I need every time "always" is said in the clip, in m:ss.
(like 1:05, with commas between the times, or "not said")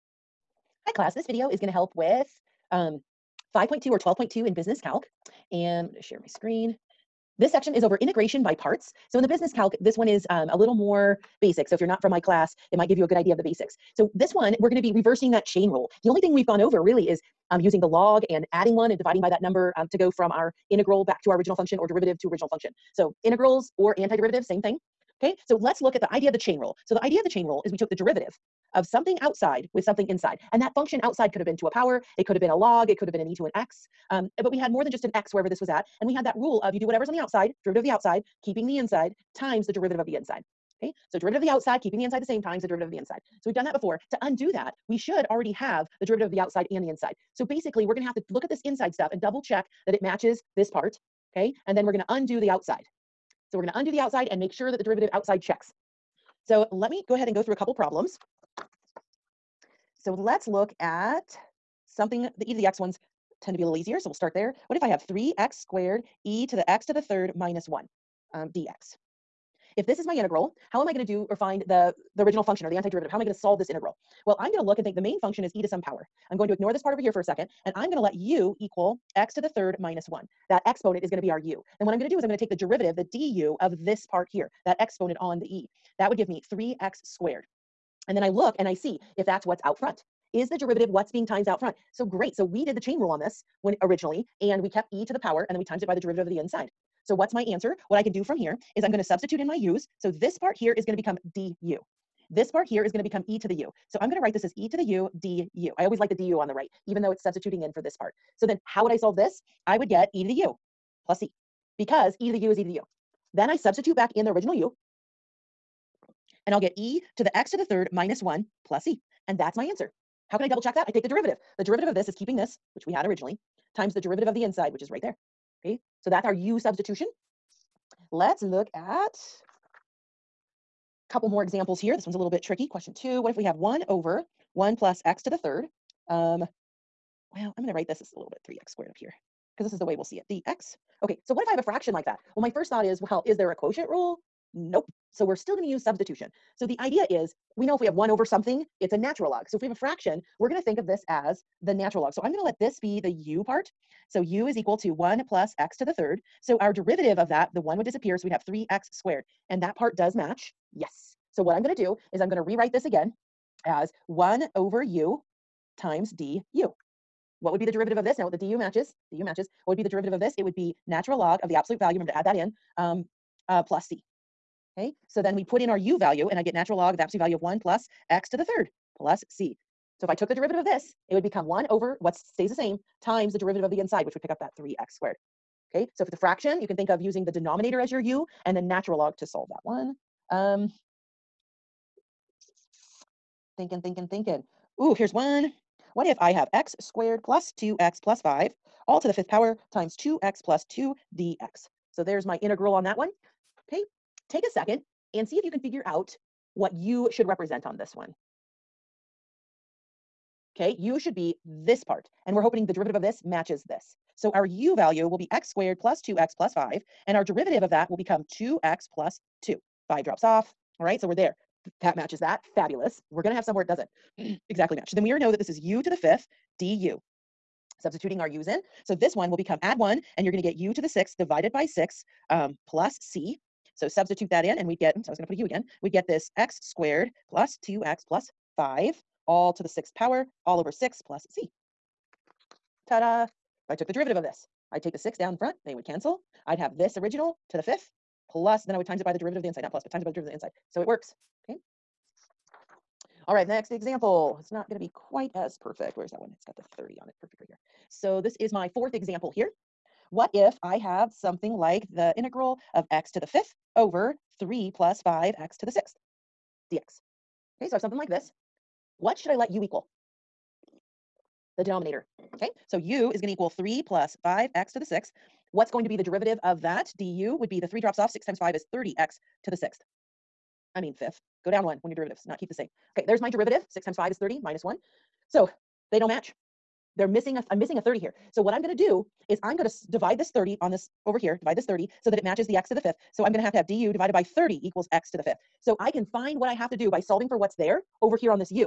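1:45.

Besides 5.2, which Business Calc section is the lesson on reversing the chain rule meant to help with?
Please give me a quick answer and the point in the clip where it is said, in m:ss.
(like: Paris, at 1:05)
12.2, at 0:03.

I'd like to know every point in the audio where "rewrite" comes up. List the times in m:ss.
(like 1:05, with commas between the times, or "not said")
2:42.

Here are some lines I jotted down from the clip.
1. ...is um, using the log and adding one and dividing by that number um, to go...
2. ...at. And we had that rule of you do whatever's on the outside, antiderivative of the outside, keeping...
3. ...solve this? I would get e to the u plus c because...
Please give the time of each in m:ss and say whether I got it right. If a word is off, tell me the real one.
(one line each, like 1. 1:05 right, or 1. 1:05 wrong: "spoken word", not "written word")
1. 0:17 right
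2. 0:35 wrong: "derivative", not "antiderivative"
3. 1:48 right.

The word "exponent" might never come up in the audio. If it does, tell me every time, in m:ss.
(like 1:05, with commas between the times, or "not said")
1:20, 1:24.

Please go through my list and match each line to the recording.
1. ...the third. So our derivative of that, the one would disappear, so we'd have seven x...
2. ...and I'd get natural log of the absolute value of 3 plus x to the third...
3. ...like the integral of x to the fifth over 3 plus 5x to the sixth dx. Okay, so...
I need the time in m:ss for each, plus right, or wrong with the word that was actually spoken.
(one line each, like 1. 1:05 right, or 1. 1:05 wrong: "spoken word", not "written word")
1. 2:35 wrong: "three", not "seven"
2. 2:56 wrong: "1", not "3"
3. 4:21 right.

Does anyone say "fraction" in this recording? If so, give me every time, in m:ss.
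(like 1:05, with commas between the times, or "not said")
2:21, 2:29, 3:06.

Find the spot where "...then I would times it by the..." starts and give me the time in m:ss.
4:08.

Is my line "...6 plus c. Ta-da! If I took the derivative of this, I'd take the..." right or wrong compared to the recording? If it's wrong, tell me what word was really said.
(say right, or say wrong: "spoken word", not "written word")
right.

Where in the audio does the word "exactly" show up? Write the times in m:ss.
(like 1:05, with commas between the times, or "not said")
3:44.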